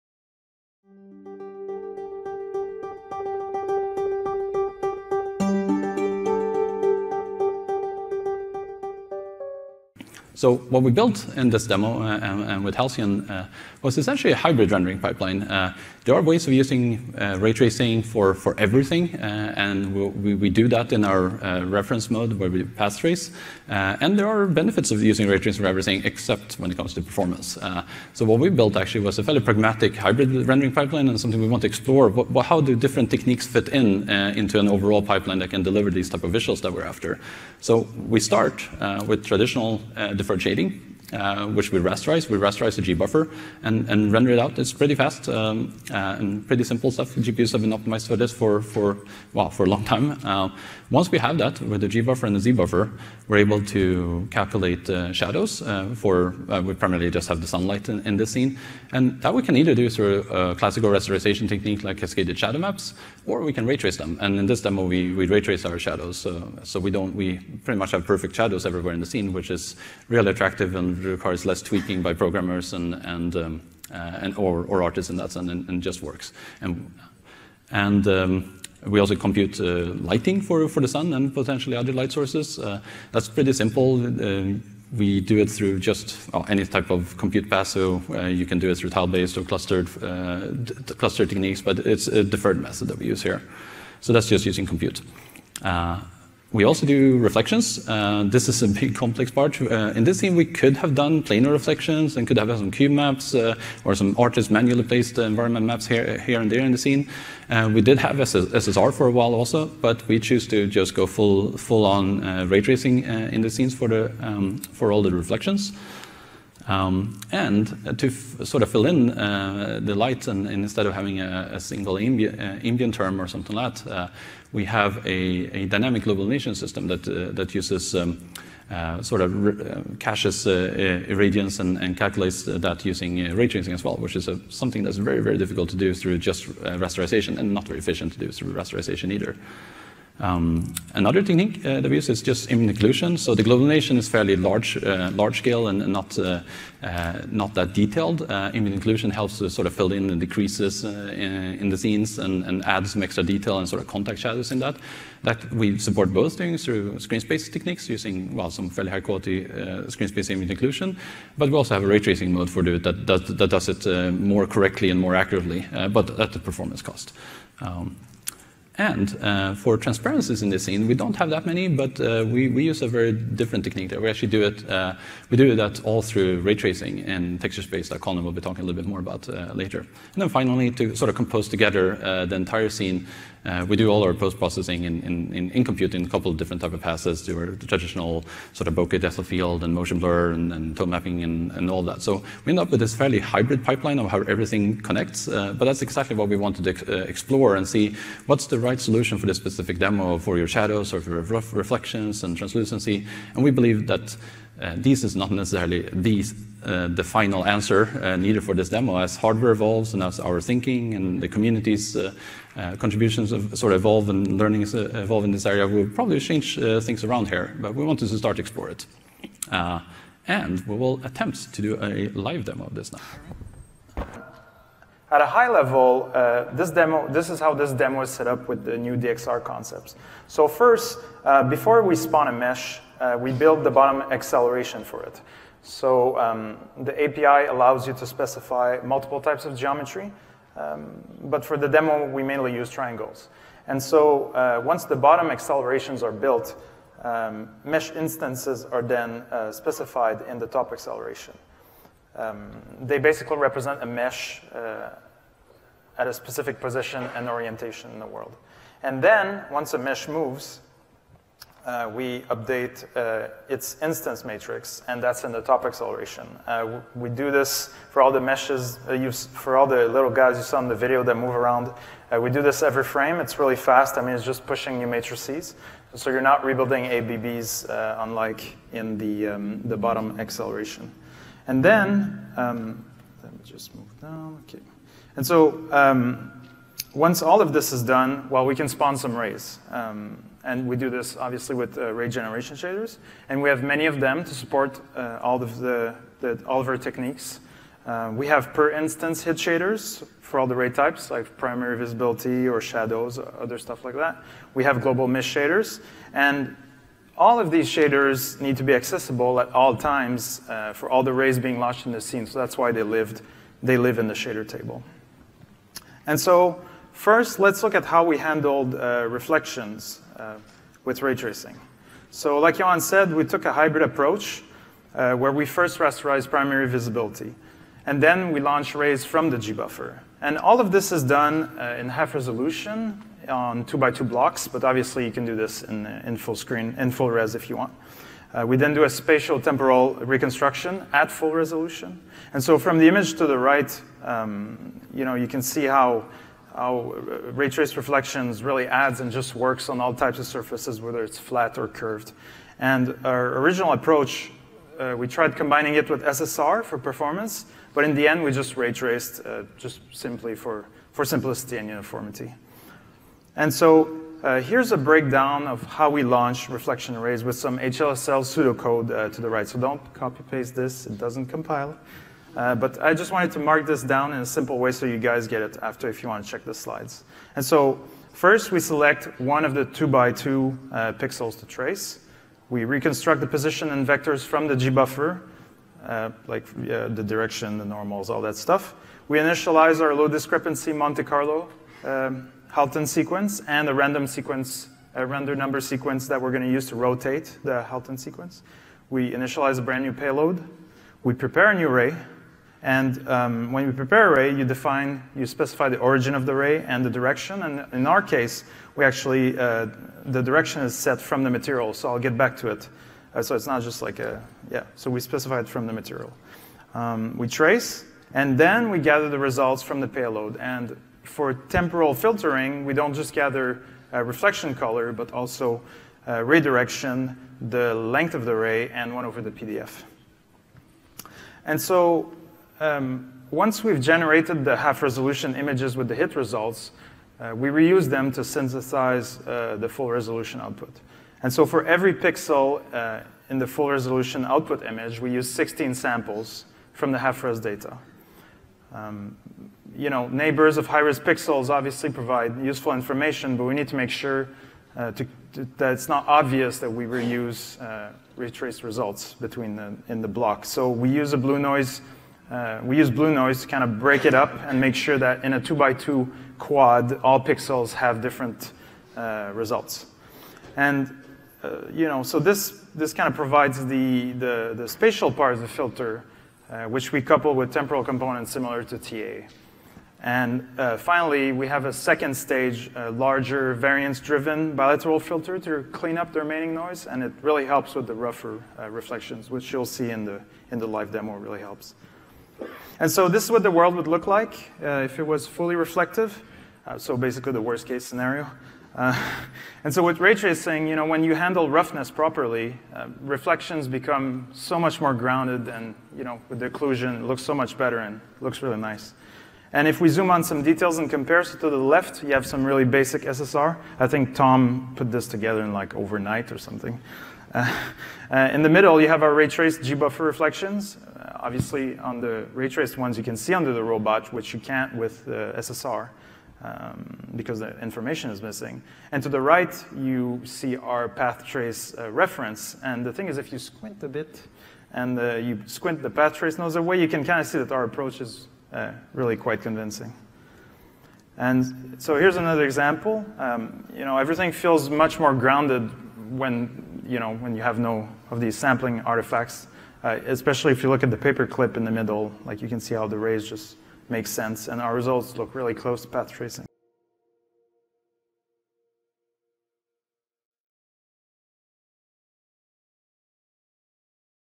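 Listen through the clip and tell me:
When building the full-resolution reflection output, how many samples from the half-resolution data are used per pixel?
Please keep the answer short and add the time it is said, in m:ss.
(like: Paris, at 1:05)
16, at 7:25.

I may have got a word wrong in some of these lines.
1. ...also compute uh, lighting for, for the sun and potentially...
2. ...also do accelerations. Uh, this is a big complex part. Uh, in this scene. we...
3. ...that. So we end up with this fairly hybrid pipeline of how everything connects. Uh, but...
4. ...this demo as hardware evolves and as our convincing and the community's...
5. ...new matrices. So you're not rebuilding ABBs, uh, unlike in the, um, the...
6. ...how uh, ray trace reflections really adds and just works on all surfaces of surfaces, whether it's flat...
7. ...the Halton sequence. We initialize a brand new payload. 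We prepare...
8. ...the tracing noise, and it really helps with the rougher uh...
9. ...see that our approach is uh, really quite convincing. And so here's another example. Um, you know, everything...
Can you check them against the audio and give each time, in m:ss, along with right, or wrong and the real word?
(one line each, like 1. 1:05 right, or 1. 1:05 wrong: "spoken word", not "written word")
1. 1:18 right
2. 1:36 wrong: "reflections", not "accelerations"
3. 3:11 right
4. 3:28 wrong: "thinking", not "convincing"
5. 4:34 right
6. 5:46 wrong: "types", not "surfaces"
7. 6:37 right
8. 8:06 wrong: "remaining", not "tracing"
9. 8:57 right.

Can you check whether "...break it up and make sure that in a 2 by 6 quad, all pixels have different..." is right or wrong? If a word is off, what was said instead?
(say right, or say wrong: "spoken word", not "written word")
wrong: "2", not "6".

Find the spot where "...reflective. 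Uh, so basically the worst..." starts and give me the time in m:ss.
8:15.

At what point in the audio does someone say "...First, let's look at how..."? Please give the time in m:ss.
5:17.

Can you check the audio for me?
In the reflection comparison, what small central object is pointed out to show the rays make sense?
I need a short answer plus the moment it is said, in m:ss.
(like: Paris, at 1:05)
paperclip, at 9:10.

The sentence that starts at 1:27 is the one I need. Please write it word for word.
so uh, you can do it through tile-based or clustered, uh, cluster techniques, but it's a deferred method that we use here.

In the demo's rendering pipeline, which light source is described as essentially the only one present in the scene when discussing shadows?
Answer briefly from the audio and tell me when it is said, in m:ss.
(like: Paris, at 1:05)
the sunlight, at 0:57.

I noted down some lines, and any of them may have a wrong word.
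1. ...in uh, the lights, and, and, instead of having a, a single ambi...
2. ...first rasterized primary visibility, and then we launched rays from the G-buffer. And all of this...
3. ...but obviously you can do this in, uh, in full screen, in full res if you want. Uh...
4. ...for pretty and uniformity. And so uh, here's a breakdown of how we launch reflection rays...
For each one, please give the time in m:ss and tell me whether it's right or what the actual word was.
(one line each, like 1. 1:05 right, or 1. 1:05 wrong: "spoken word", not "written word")
1. 1:58 right
2. 5:25 right
3. 5:34 right
4. 6:00 wrong: "simplicity", not "pretty".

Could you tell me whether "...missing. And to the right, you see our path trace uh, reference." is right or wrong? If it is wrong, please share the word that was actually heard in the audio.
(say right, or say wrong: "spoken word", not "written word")
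right.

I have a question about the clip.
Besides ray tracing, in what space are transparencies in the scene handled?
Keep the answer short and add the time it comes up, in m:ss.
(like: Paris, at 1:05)
texture space, at 2:57.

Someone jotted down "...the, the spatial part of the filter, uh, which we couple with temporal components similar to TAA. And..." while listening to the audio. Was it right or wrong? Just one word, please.
right.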